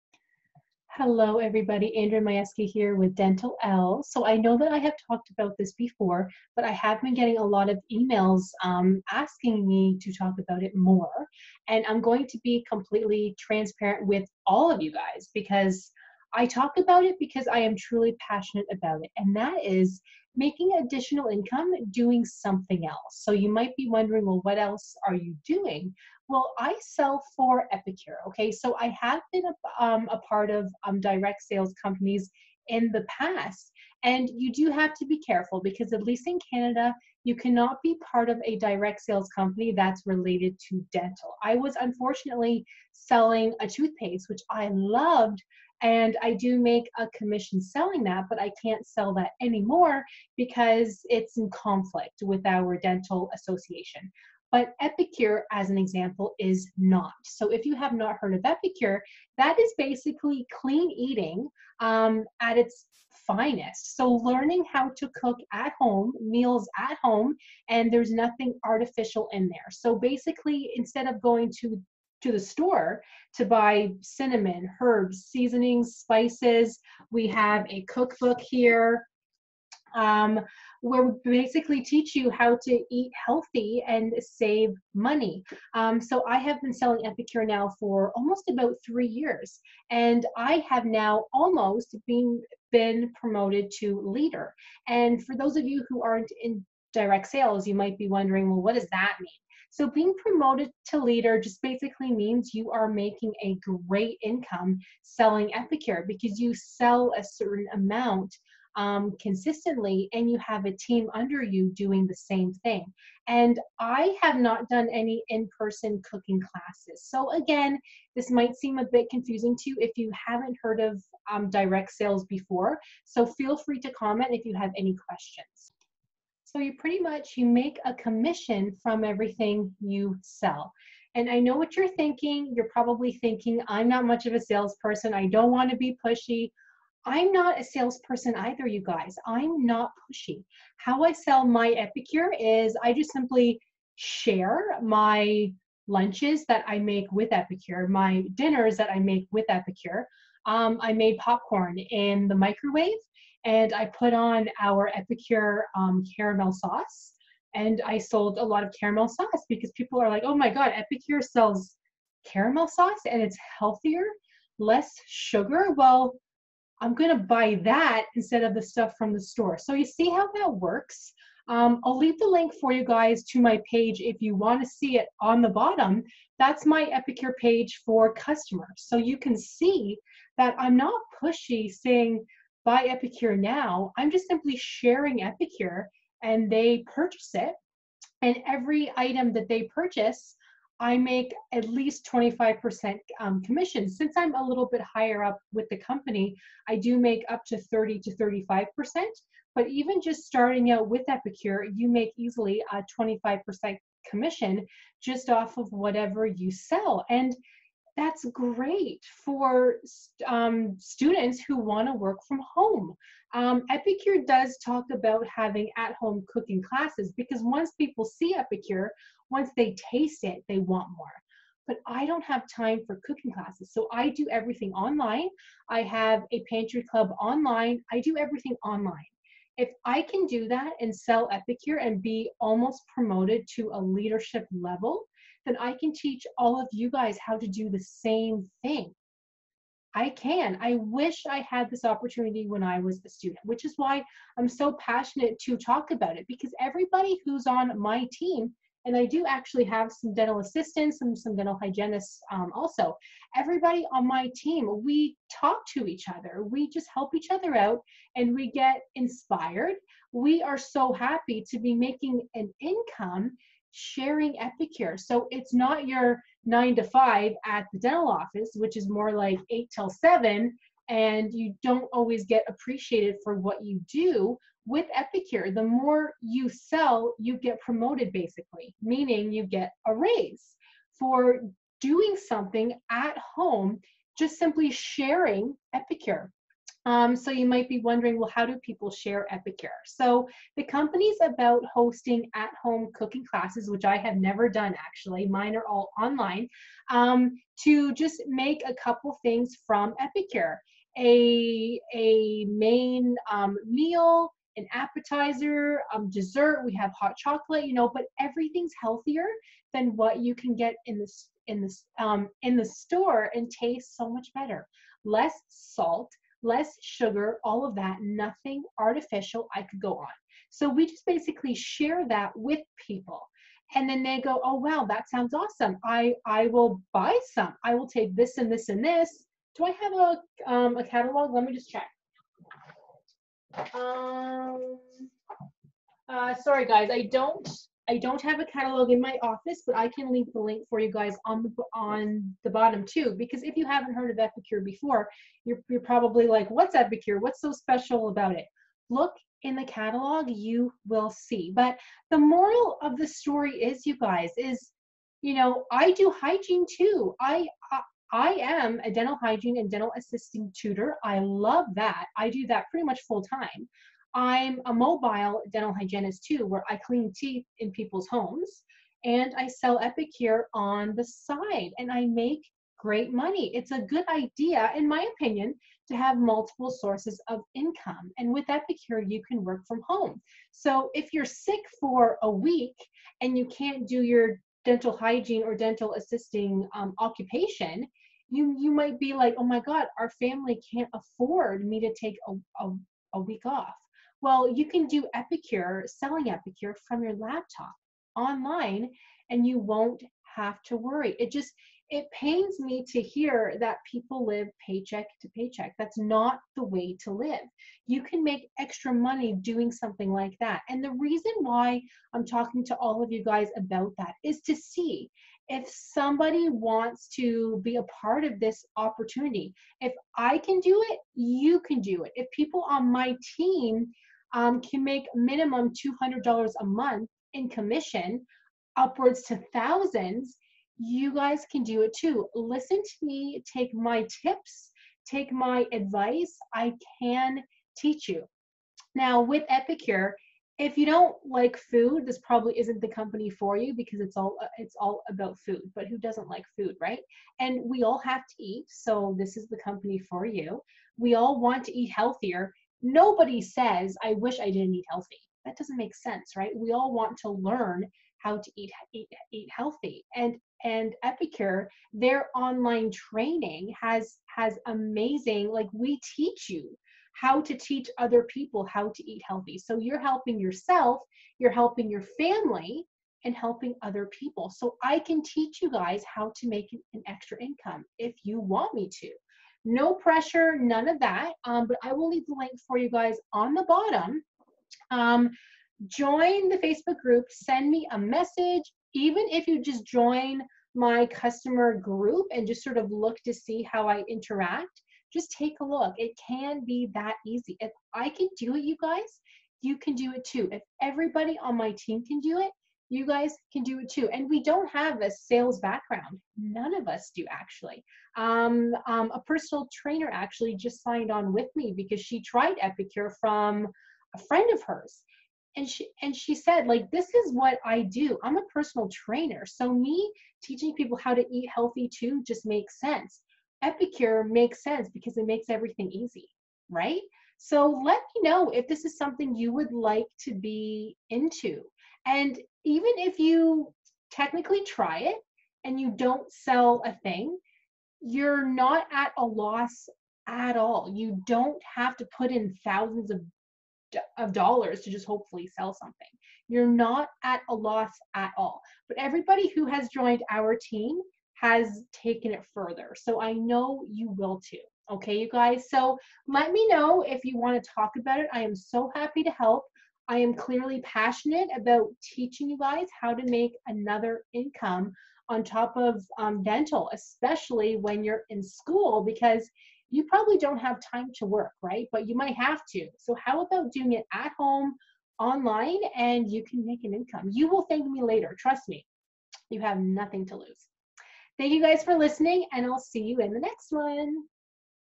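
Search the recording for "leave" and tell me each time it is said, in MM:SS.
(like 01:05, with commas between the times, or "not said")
02:51, 05:40, 08:02.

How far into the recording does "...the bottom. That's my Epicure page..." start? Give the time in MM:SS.
02:55.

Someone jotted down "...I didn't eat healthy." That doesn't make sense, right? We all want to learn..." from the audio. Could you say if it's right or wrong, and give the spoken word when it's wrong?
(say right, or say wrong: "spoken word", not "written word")
right.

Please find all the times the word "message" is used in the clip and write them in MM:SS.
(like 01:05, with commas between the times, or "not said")
08:07.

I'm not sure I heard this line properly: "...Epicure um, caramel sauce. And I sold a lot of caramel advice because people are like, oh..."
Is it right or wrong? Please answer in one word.
wrong.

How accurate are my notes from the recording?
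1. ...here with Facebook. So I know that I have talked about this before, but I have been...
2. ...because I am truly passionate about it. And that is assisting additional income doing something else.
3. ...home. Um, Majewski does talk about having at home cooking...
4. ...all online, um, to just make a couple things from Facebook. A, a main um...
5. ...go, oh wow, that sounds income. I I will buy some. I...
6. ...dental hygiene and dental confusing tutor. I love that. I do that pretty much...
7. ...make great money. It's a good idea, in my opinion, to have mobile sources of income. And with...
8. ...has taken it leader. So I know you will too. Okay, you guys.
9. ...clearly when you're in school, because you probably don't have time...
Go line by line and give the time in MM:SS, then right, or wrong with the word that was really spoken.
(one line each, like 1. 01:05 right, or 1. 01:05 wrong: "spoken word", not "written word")
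1. 00:02 wrong: "Dentalelle", not "Facebook"
2. 00:17 wrong: "making", not "assisting"
3. 03:32 wrong: "Epicure", not "Majewski"
4. 04:55 wrong: "Epicure", not "Facebook"
5. 05:24 wrong: "awesome", not "income"
6. 05:58 wrong: "assisting", not "confusing"
7. 06:12 wrong: "multiple", not "mobile"
8. 09:11 wrong: "further", not "leader"
9. 09:26 wrong: "especially", not "clearly".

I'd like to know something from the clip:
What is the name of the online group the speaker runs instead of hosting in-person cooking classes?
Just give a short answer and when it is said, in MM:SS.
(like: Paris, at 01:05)
pantry club, at 03:46.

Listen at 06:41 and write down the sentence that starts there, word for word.
It just it pains me to hear that people live paycheck to paycheck.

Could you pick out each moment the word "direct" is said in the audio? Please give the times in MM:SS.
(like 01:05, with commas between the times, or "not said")
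00:31, 00:38, 01:36, 02:01.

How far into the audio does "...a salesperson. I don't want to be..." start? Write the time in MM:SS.
02:14.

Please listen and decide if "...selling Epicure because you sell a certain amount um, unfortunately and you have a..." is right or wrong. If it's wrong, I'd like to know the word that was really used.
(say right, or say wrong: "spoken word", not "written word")
wrong: "consistently", not "unfortunately".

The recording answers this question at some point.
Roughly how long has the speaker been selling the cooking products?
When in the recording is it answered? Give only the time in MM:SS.
01:28.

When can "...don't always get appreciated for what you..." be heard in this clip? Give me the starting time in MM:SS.
04:31.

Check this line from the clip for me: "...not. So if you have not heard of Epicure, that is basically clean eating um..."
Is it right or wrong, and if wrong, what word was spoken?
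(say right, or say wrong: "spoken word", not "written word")
right.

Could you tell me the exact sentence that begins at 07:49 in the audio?
So you're helping yourself, you're helping your family, and helping other people.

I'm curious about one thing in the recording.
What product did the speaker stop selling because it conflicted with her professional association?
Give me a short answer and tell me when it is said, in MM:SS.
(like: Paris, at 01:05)
toothpaste, at 00:43.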